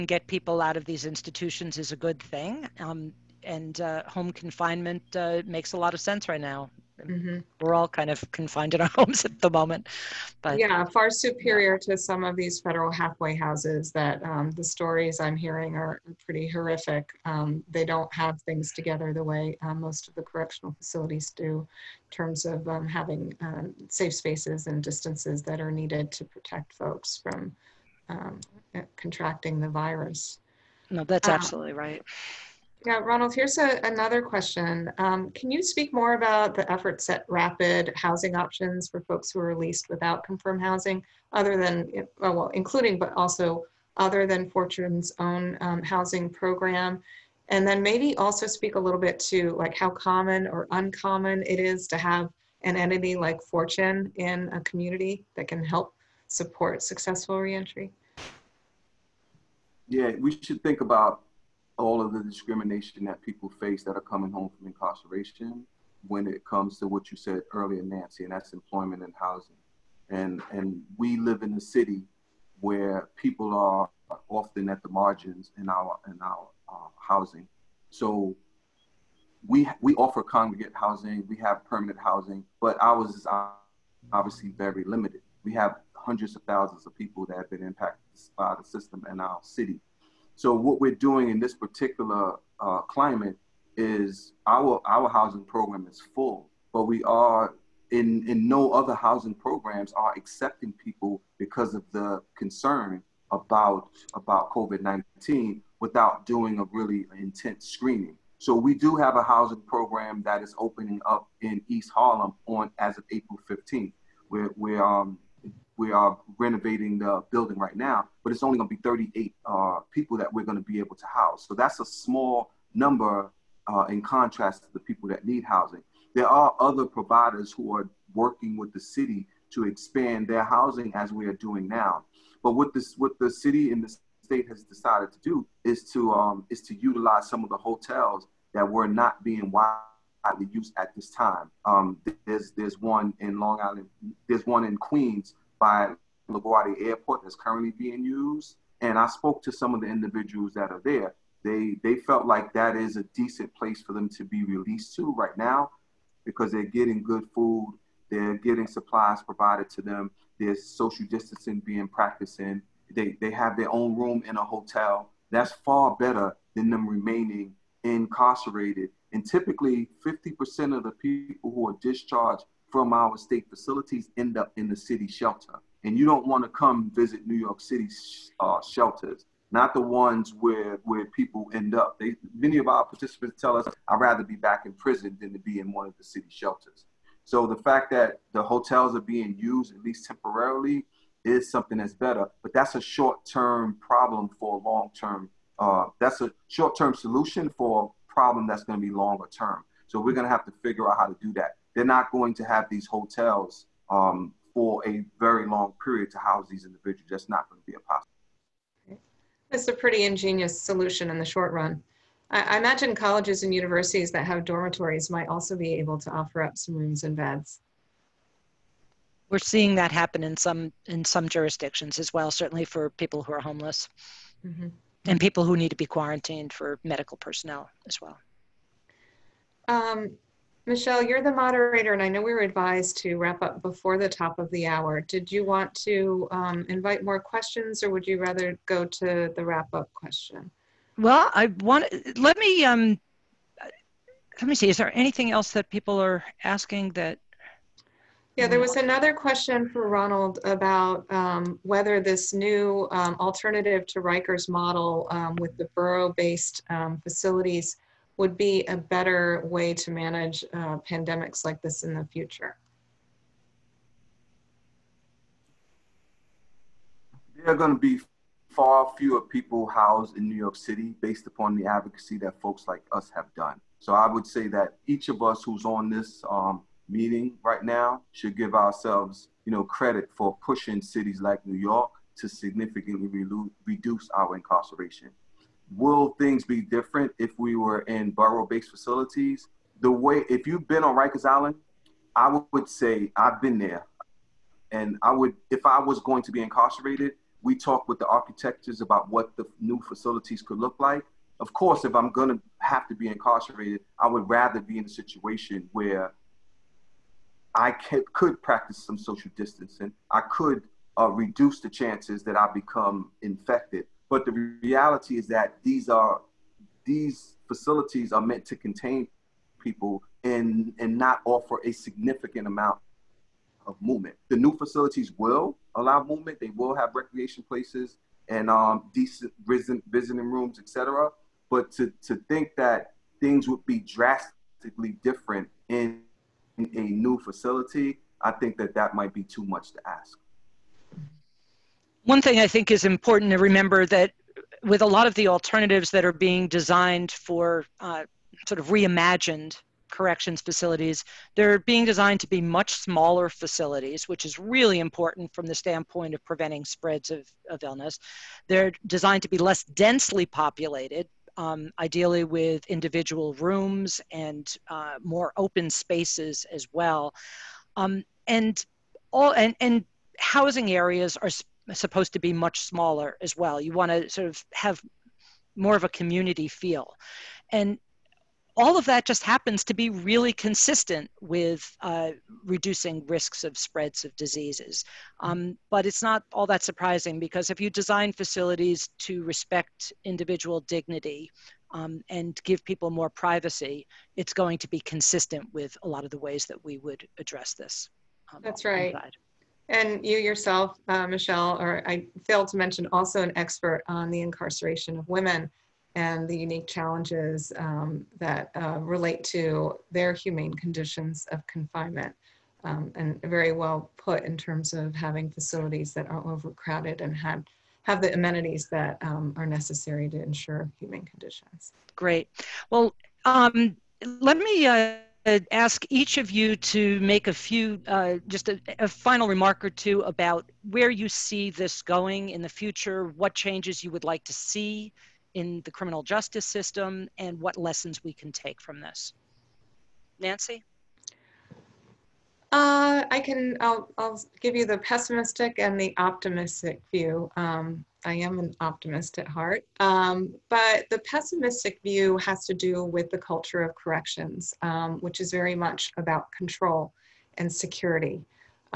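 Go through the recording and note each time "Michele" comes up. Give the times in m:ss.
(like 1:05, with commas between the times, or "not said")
3:50, 6:41.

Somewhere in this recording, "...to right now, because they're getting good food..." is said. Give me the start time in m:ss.
2:34.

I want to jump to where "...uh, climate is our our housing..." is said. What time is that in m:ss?
1:32.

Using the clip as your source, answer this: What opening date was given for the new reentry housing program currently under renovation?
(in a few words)
April 15.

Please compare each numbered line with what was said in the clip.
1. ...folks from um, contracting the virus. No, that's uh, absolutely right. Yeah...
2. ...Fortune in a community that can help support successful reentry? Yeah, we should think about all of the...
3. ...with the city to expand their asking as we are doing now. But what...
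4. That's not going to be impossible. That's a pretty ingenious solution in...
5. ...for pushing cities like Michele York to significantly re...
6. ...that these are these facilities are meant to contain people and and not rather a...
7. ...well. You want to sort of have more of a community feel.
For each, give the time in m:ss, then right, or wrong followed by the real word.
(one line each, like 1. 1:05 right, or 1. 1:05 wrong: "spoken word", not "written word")
1. 0:26 right
2. 0:53 right
3. 2:08 wrong: "housing", not "asking"
4. 3:27 right
5. 4:40 wrong: "New", not "Michele"
6. 5:15 wrong: "offer", not "rather"
7. 6:13 right.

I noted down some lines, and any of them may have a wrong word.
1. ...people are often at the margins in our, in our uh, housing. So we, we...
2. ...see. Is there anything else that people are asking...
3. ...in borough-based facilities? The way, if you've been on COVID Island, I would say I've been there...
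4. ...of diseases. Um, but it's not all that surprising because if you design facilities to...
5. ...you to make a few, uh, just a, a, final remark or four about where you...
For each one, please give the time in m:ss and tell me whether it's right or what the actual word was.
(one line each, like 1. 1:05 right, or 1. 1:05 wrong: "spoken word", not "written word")
1. 1:13 right
2. 4:04 right
3. 4:47 wrong: "Rikers", not "COVID"
4. 6:24 right
5. 7:06 wrong: "two", not "four".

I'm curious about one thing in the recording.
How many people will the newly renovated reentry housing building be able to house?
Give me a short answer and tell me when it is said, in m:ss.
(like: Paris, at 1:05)
38, at 1:58.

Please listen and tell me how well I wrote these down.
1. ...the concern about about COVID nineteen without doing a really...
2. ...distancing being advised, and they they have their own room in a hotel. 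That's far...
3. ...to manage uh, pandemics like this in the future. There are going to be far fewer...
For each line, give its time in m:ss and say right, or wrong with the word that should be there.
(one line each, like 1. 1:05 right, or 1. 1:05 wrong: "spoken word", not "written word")
1. 1:41 right
2. 2:41 wrong: "practiced", not "advised"
3. 4:19 right.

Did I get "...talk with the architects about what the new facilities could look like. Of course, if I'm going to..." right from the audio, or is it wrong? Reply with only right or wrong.
right.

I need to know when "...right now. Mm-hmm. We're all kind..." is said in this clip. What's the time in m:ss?
0:06.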